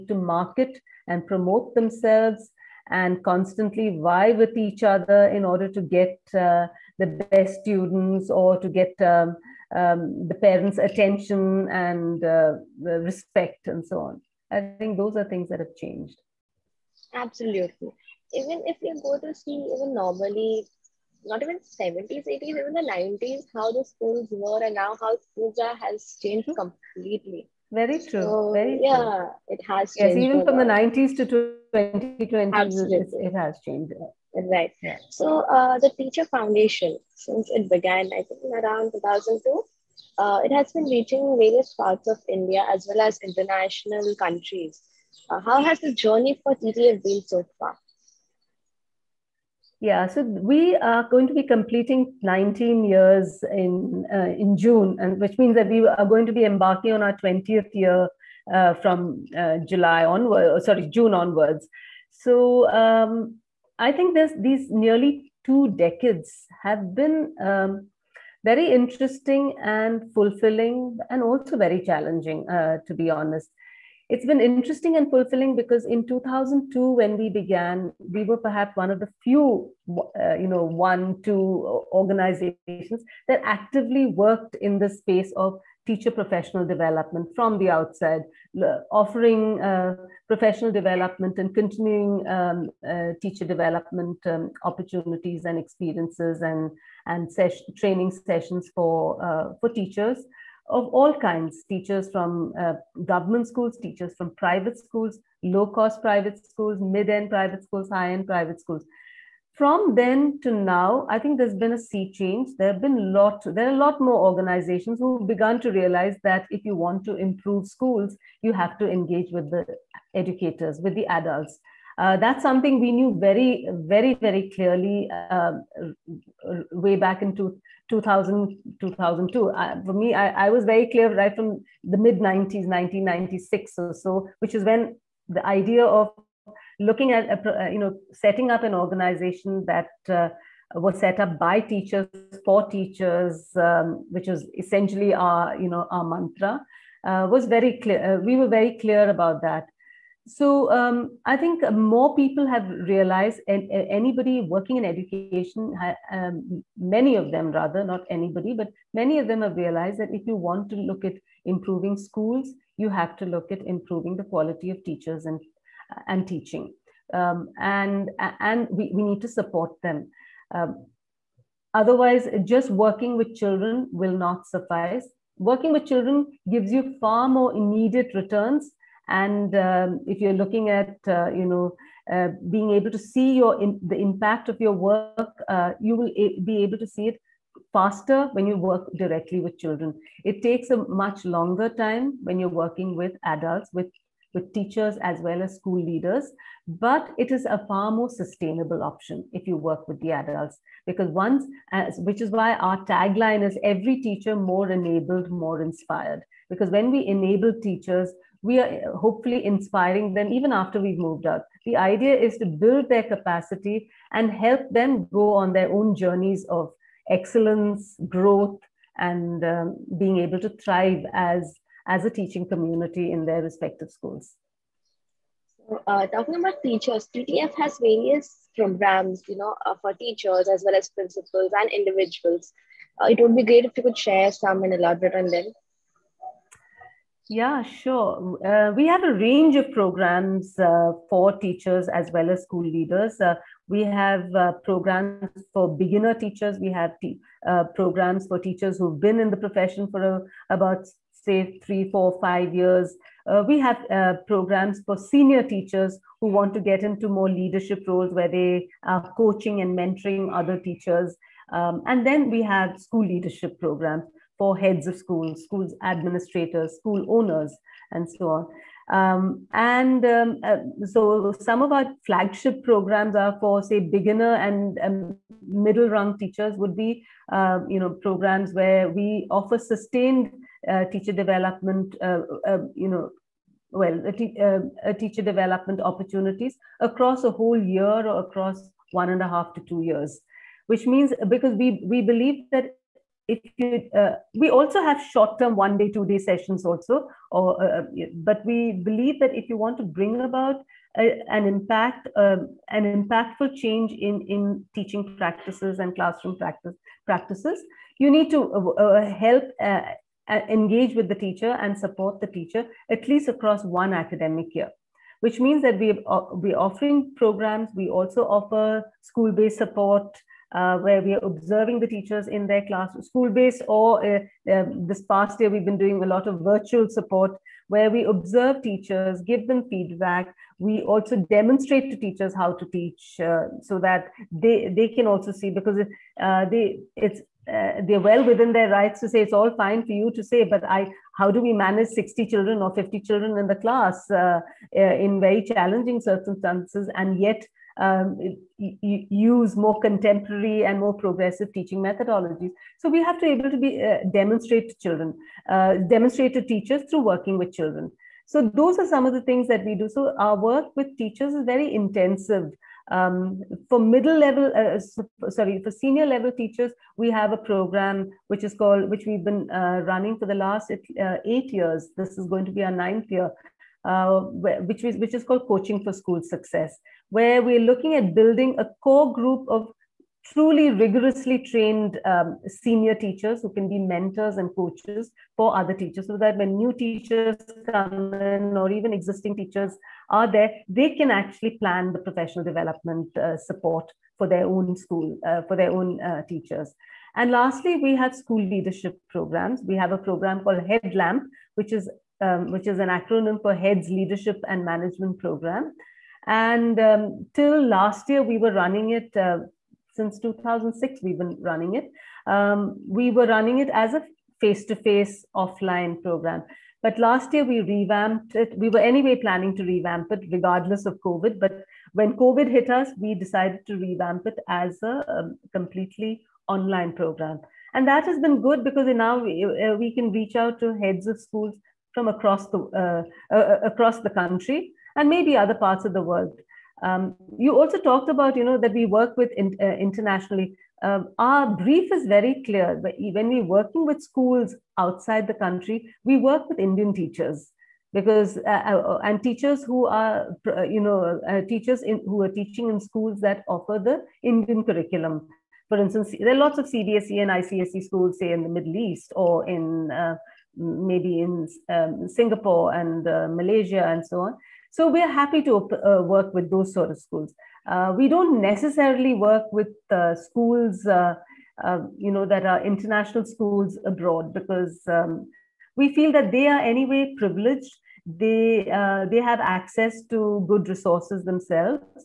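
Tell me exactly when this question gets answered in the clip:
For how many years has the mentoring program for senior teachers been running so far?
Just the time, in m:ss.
6:11.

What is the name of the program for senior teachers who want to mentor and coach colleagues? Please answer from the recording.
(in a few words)
Coaching for School Success.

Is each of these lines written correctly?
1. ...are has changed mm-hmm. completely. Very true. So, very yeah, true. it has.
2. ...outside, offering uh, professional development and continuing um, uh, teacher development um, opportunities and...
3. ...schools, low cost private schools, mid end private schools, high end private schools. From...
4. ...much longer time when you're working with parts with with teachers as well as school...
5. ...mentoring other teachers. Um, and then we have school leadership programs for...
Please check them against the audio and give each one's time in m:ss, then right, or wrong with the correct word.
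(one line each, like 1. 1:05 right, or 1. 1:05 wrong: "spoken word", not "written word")
1. 0:25 right
2. 1:27 right
3. 1:44 right
4. 3:10 wrong: "adults", not "parts"
5. 4:19 right.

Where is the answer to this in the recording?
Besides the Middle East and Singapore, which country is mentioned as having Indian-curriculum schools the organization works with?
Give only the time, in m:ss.
7:43.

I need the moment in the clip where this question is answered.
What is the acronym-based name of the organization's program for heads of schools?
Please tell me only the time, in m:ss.
6:40.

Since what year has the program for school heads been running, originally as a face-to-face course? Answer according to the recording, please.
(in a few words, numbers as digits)
2006.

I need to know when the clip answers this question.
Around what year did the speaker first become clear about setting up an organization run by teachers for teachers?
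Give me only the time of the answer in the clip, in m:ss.
2:12.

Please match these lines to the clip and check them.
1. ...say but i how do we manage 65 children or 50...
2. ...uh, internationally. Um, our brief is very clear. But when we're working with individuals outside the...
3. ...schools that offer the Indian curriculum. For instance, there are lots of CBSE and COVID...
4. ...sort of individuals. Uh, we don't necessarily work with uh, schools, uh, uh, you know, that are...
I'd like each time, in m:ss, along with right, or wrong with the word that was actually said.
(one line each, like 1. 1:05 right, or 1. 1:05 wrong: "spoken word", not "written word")
1. 5:40 wrong: "60", not "65"
2. 7:19 wrong: "schools", not "individuals"
3. 7:32 wrong: "ICSE", not "COVID"
4. 7:46 wrong: "schools", not "individuals".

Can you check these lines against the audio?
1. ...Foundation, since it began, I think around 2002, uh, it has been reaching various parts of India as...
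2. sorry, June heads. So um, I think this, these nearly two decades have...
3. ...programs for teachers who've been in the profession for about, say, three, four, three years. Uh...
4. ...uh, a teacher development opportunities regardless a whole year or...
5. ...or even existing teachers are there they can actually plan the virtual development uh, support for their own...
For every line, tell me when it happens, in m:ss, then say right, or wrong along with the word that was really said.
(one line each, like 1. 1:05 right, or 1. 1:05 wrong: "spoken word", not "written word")
1. 0:36 right
2. 1:00 wrong: "onwards", not "heads"
3. 4:07 wrong: "five", not "three"
4. 4:44 wrong: "across", not "regardless"
5. 6:28 wrong: "professional", not "virtual".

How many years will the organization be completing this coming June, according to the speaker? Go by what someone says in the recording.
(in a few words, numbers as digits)
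19.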